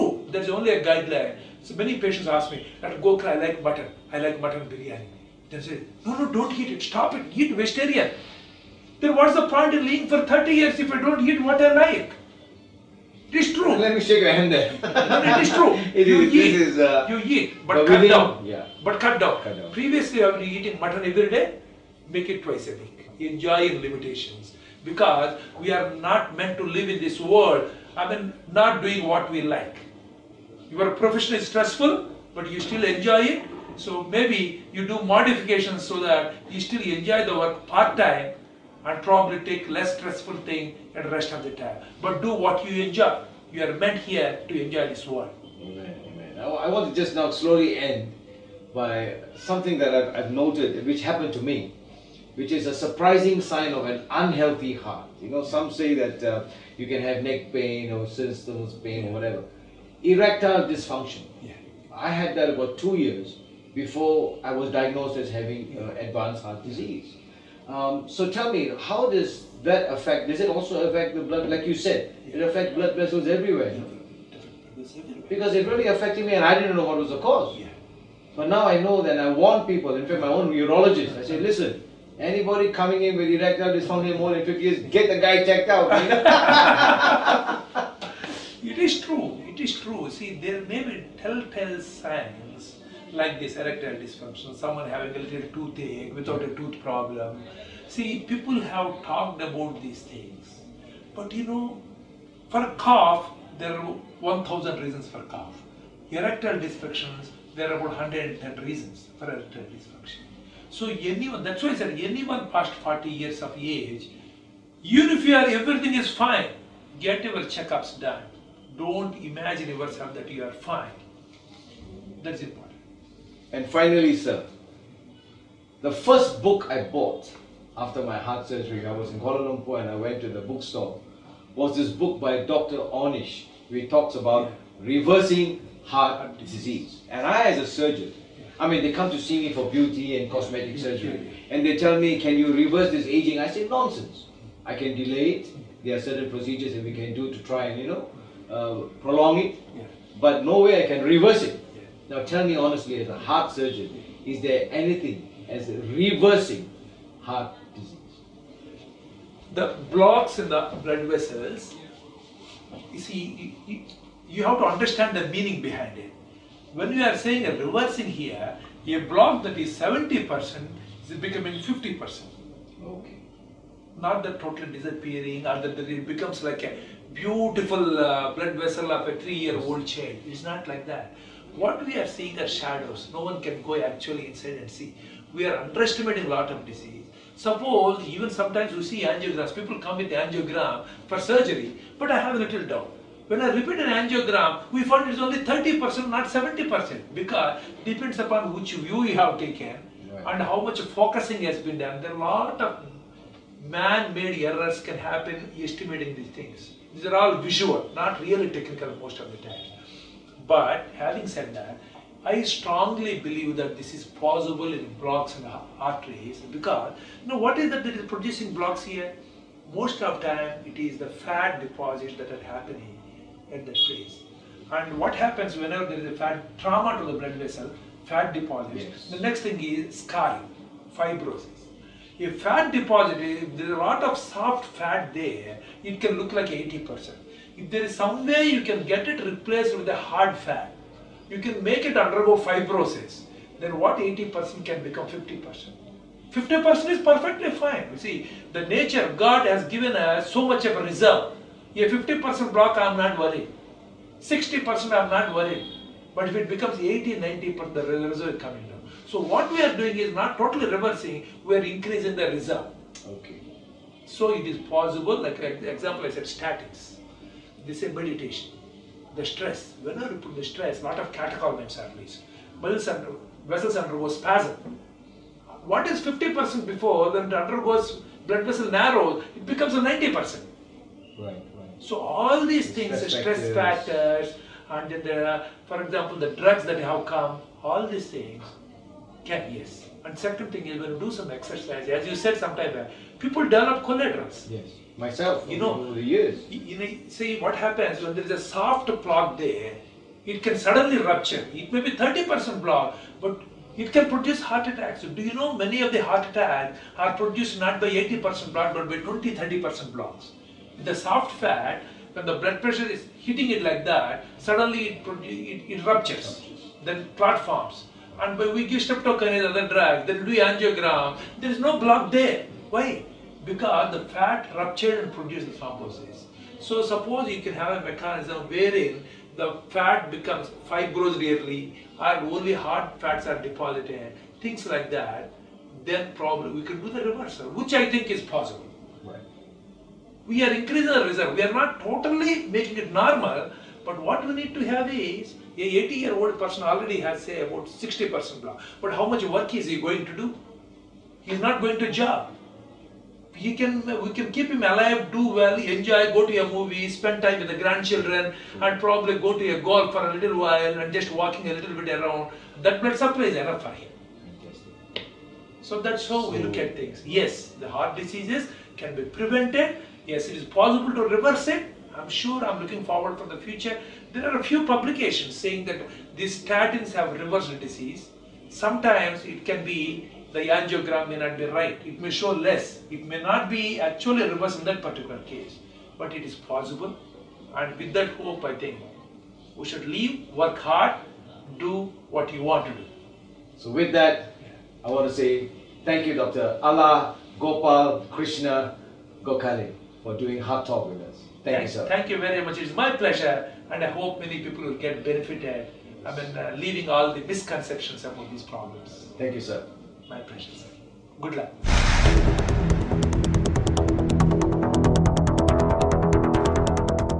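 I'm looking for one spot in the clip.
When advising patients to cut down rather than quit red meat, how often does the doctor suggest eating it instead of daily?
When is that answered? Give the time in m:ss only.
0:22.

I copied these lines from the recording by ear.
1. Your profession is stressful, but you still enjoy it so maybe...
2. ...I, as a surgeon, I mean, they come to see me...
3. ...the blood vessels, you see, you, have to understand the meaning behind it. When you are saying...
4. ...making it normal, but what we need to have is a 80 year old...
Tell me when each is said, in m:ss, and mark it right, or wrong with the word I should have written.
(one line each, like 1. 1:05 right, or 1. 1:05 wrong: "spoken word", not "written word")
1. 0:30 right
2. 2:17 right
3. 2:40 right
4. 5:42 right.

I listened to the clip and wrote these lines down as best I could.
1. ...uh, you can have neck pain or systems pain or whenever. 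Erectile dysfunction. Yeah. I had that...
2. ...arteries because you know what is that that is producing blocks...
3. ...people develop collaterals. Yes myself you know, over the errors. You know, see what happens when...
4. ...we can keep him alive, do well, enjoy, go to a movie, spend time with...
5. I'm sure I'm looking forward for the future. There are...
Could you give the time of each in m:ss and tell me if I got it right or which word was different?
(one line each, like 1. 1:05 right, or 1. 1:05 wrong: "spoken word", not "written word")
1. 0:56 wrong: "whatever", not "whenever"
2. 3:35 right
3. 4:53 wrong: "years", not "errors"
4. 5:54 right
5. 6:11 right.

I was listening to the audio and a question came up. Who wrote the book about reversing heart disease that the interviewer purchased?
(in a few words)
Dr. Ornish.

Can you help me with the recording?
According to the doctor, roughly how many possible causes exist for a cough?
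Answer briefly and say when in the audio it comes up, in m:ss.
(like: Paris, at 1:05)
1000, at 1:44.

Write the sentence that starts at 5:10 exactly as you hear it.
The soft fat, when the blood pressure is hitting it like that, suddenly it, it, it ruptures.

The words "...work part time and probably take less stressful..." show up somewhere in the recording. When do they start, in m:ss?
0:37.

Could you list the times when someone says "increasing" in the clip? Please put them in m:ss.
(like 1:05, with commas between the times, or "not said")
4:21, 5:40.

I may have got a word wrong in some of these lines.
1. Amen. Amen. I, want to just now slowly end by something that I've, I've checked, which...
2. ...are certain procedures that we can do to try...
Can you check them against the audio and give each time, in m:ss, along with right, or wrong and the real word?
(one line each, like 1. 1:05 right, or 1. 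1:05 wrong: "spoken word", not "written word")
1. 0:45 wrong: "noted", not "checked"
2. 2:25 right.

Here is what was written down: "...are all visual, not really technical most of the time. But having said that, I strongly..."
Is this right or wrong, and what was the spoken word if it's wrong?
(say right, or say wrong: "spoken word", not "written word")
right.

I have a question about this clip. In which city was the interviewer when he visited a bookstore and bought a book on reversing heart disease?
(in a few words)
Kuala Lumpur.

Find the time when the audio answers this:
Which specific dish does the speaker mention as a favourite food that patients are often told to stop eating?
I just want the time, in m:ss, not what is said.
0:04.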